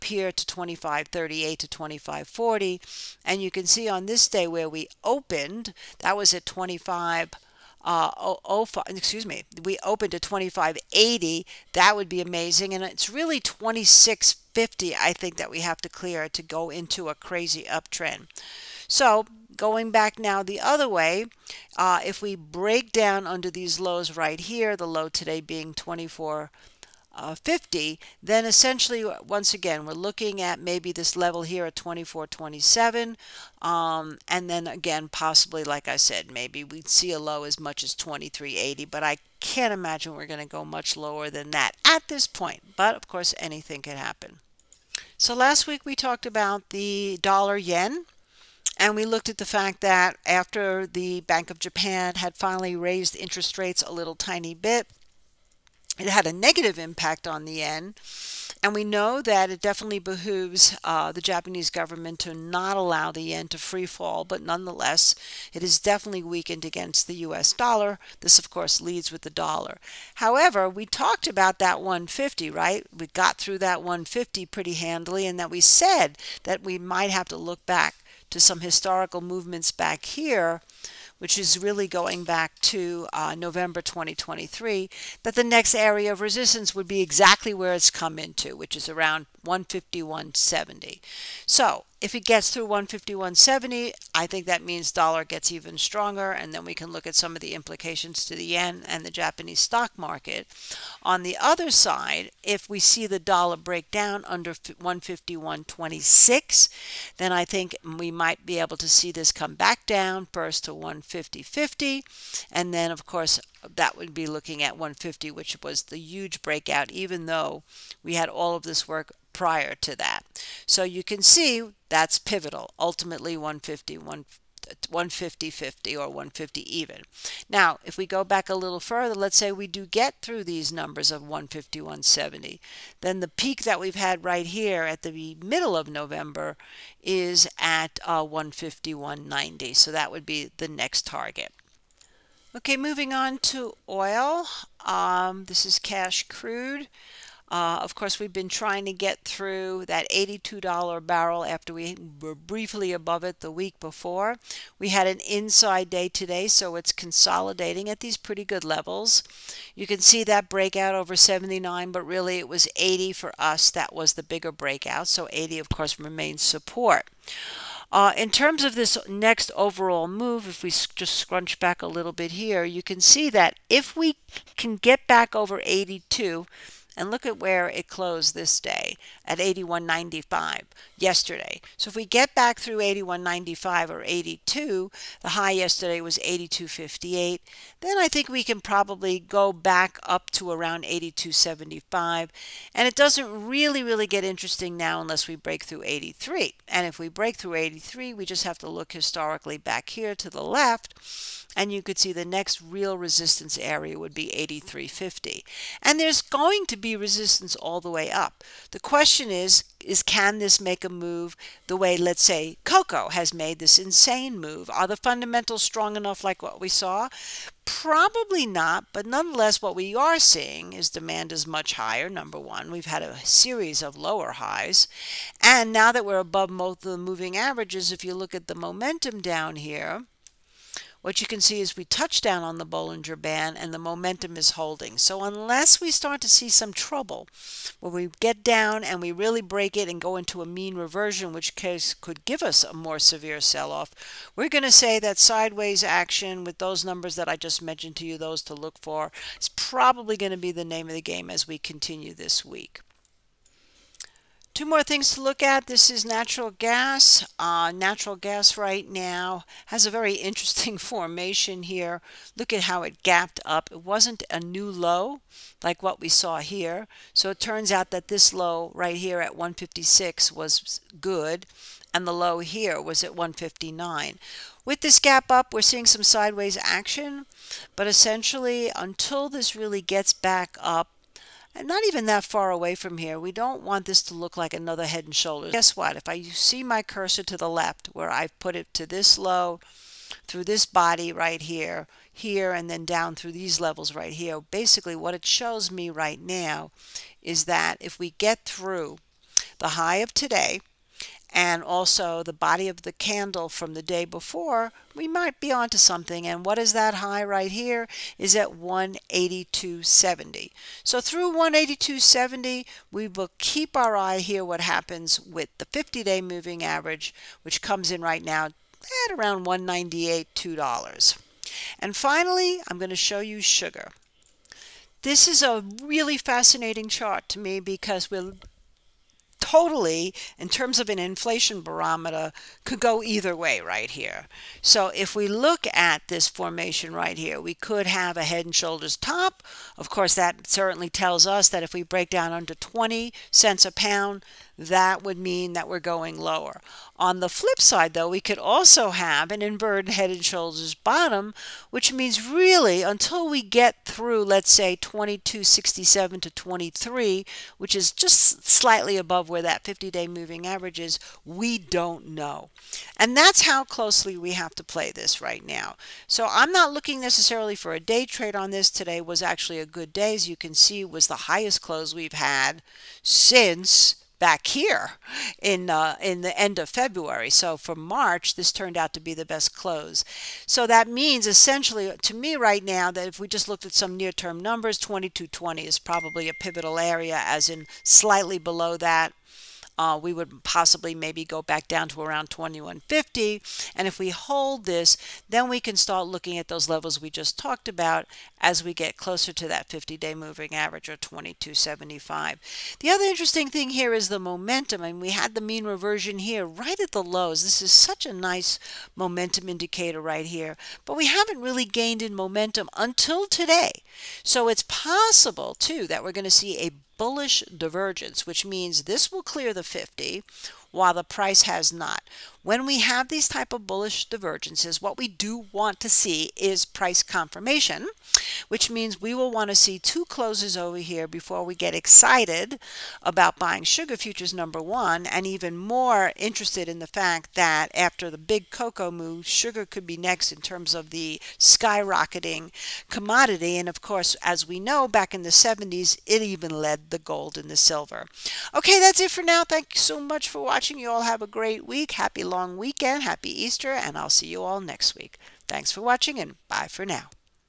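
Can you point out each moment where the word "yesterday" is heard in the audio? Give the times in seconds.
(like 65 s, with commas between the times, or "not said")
180 s, 185 s.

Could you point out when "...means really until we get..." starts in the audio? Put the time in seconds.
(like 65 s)
351 s.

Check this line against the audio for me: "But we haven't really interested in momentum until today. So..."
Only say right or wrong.
wrong.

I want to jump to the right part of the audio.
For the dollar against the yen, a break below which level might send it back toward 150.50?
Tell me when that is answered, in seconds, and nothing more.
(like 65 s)
104 s.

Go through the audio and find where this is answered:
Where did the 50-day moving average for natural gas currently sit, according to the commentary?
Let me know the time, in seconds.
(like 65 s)
319 s.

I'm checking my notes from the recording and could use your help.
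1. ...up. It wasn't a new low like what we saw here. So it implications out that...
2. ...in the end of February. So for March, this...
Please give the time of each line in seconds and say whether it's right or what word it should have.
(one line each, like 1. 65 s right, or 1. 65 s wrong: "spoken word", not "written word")
1. 263 s wrong: "turns", not "implications"
2. 376 s right.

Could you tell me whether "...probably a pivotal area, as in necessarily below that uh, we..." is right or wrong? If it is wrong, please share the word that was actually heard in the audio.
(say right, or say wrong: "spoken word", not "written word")
wrong: "slightly", not "necessarily".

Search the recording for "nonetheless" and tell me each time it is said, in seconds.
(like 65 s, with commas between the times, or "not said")
64 s, 219 s.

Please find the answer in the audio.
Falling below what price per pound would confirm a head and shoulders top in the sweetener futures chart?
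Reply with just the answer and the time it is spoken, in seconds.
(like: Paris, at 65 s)
20 cents, at 342 s.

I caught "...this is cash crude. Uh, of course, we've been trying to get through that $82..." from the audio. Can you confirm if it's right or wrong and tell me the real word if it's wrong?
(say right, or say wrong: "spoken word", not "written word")
right.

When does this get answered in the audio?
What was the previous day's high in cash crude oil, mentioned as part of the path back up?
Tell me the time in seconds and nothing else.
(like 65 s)
186 s.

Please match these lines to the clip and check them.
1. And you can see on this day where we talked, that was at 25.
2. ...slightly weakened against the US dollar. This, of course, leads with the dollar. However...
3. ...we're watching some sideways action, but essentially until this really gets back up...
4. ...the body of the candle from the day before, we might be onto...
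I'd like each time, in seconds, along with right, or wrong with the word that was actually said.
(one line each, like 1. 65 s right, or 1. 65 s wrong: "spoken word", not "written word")
1. 3 s wrong: "opened", not "talked"
2. 65 s wrong: "definitely", not "slightly"
3. 275 s wrong: "seeing", not "watching"
4. 302 s right.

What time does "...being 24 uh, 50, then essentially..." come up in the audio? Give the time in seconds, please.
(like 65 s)
25 s.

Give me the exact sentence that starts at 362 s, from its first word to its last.
And that's how closely we have to play this right now.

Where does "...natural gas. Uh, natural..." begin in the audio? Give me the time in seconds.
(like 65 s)
256 s.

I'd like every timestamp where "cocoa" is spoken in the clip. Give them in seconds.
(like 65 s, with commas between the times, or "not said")
212 s, 438 s.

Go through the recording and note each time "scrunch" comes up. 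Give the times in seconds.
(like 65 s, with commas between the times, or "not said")
171 s.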